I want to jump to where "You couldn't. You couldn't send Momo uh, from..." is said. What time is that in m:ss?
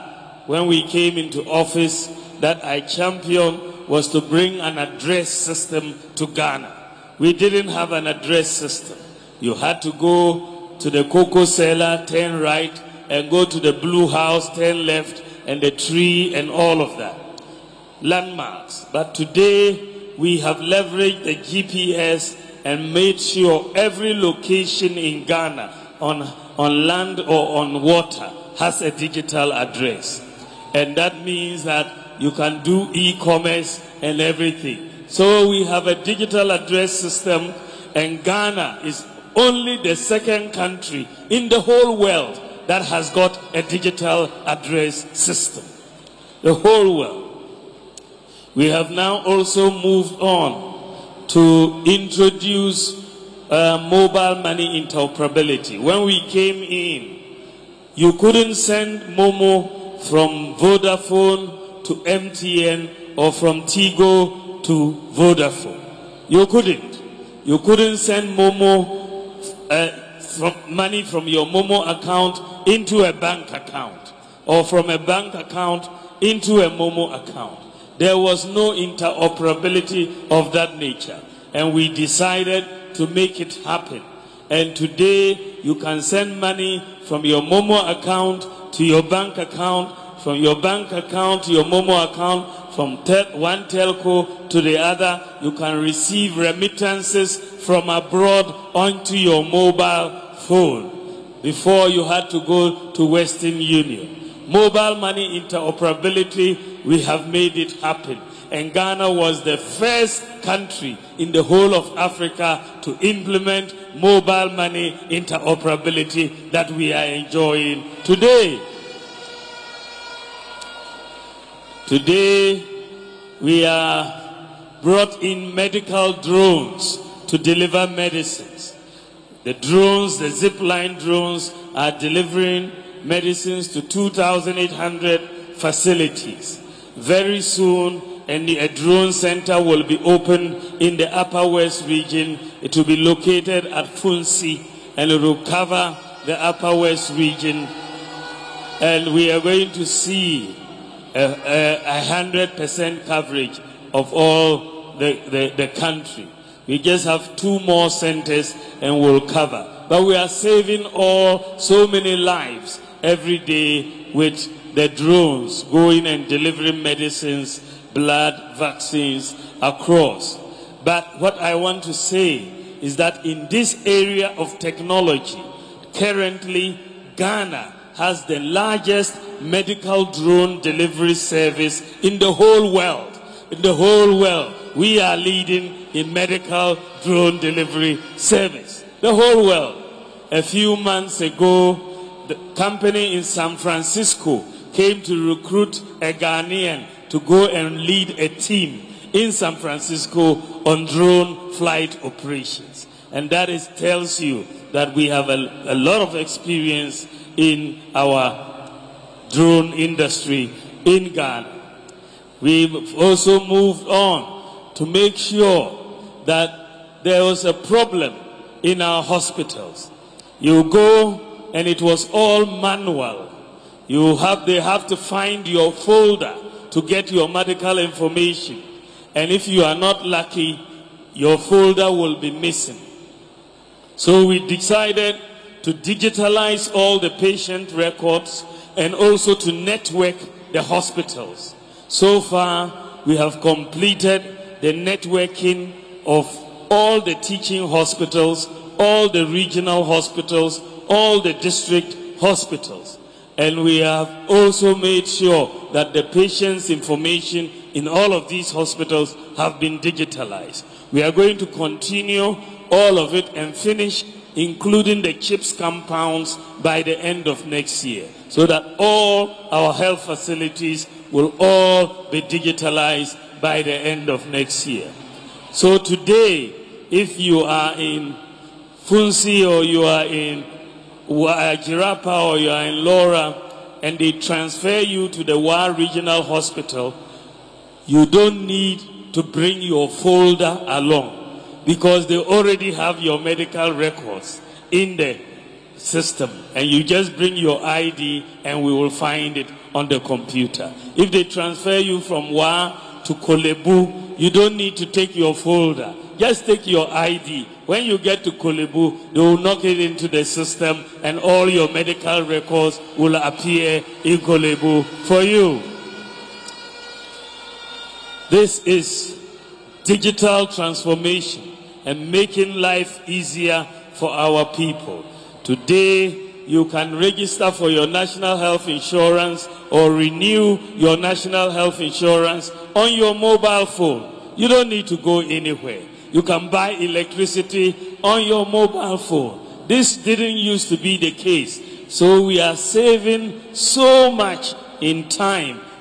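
1:06.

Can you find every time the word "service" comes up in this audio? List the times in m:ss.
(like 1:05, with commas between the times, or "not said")
3:01, 3:08.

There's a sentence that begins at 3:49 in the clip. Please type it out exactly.
And if you are not lucky, your folder will be missing.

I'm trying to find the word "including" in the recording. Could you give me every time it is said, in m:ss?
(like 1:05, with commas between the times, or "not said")
4:24.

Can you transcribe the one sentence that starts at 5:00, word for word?
If they transfer you from Wa to Korle Bu, you don't need to take your folder.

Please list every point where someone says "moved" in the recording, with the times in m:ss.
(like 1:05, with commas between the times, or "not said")
0:49, 3:33.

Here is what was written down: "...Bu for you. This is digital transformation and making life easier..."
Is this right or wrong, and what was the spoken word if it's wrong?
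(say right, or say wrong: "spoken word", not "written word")
right.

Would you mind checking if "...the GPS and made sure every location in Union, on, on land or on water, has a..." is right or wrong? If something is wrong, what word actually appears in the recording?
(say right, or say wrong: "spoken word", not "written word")
wrong: "Ghana", not "Union".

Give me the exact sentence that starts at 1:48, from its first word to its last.
And Ghana was the first country in the whole of Africa to implement mobile money interoperability that we are enjoying today.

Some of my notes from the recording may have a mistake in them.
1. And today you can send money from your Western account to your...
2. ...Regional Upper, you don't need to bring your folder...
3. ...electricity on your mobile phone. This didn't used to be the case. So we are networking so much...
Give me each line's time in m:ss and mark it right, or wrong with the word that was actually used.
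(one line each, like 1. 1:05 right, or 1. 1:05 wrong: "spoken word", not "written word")
1. 1:24 wrong: "Momo", not "Western"
2. 4:45 wrong: "Hospital", not "Upper"
3. 5:36 wrong: "saving", not "networking".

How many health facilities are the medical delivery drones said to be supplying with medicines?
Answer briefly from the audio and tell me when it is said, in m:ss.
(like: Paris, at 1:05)
2,800, at 2:13.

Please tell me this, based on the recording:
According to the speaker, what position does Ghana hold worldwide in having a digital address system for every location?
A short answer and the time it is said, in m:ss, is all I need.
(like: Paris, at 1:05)
second, at 0:39.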